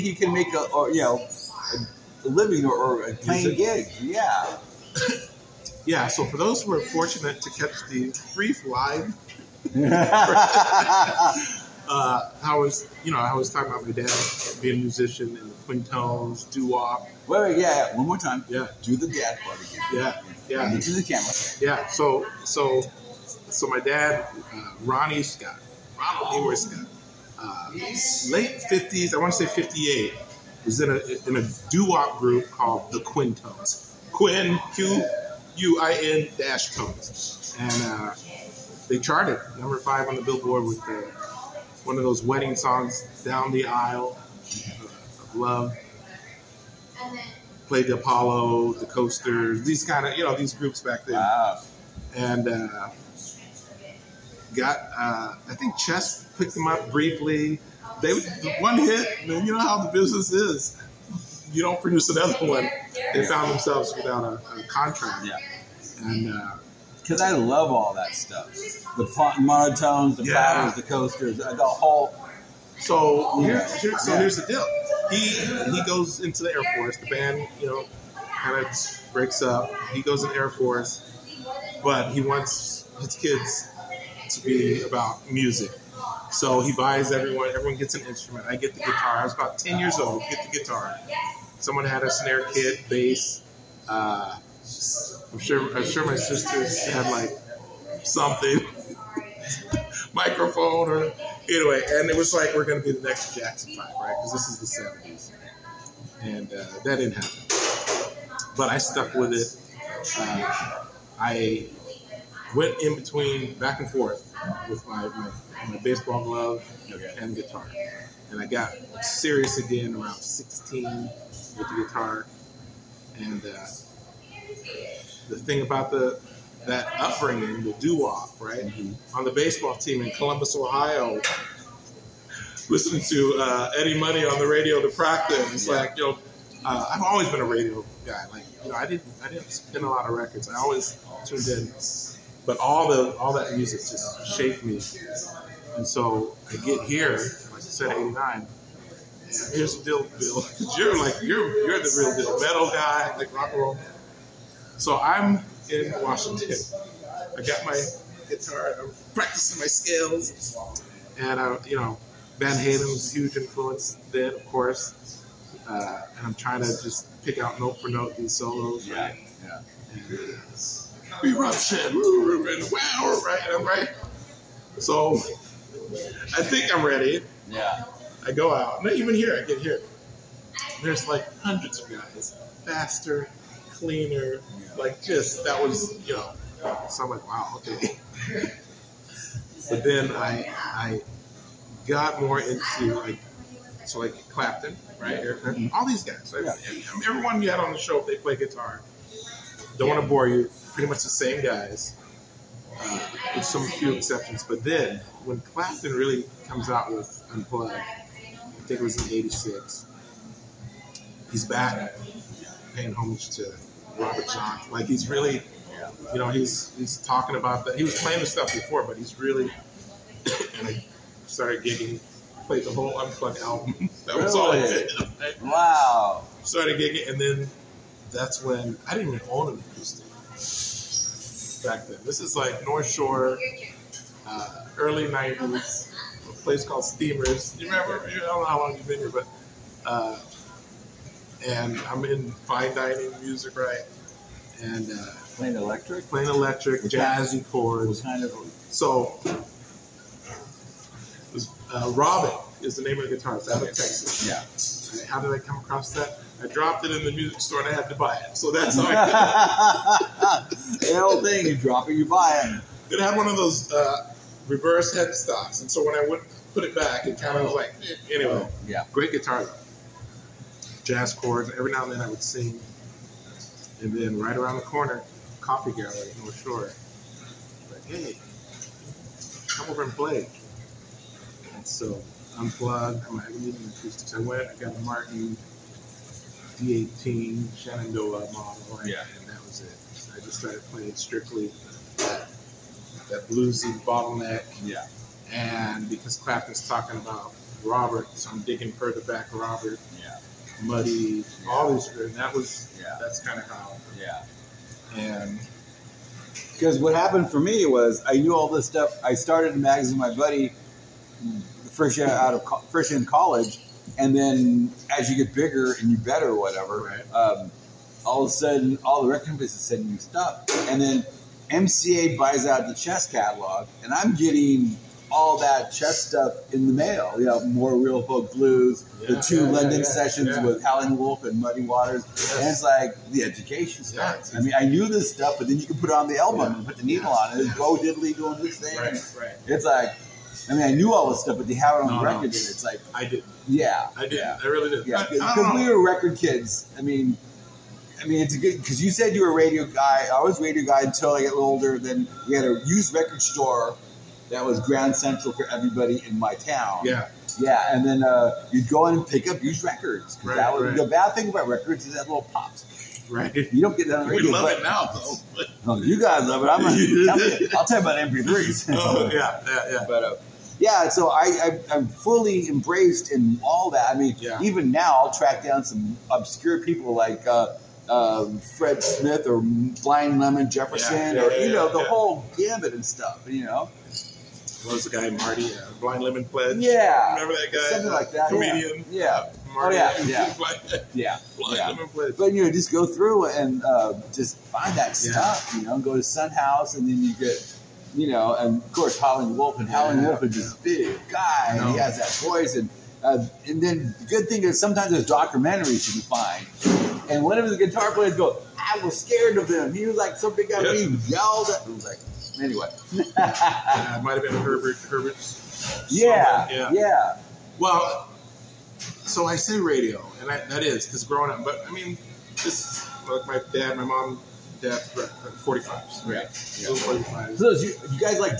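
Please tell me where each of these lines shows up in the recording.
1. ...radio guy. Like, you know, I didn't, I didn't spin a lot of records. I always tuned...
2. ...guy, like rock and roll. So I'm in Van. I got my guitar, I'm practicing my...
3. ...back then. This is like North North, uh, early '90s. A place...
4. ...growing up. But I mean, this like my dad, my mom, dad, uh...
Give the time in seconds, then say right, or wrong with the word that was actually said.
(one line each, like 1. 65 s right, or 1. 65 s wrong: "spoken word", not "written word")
1. 137 s right
2. 152 s wrong: "Washington", not "Van"
3. 231 s wrong: "Shore", not "North"
4. 421 s right.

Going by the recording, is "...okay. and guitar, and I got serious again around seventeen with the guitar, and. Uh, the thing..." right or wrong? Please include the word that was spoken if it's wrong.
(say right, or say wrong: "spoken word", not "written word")
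wrong: "sixteen", not "seventeen".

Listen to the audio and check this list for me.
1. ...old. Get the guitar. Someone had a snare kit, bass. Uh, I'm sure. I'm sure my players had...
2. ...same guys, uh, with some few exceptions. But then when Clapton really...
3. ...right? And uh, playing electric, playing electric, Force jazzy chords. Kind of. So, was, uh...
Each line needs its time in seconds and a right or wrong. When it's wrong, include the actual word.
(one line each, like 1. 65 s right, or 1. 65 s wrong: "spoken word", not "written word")
1. 89 s wrong: "sisters", not "players"
2. 201 s right
3. 243 s wrong: "With", not "Force".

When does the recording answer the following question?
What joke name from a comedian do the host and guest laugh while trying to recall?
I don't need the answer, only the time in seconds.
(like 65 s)
385 s.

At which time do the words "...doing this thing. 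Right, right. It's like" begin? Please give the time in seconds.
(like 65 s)
338 s.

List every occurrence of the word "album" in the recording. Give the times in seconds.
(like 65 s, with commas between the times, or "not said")
223 s, 336 s.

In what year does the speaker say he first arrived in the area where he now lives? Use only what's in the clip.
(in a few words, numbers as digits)
1989.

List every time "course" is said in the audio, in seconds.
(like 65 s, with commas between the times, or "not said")
164 s, 398 s.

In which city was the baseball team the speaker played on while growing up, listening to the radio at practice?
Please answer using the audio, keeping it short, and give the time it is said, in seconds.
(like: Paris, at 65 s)
Columbus, Ohio, at 130 s.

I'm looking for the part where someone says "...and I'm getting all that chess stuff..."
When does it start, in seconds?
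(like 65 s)
323 s.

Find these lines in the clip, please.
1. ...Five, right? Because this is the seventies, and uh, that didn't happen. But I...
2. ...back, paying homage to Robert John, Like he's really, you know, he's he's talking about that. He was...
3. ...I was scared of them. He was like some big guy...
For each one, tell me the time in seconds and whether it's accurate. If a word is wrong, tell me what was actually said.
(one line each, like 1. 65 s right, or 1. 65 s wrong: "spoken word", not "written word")
1. 103 s right
2. 211 s right
3. 408 s right.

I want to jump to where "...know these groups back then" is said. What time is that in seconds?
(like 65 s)
50 s.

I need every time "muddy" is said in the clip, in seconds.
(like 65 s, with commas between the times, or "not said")
300 s, 331 s.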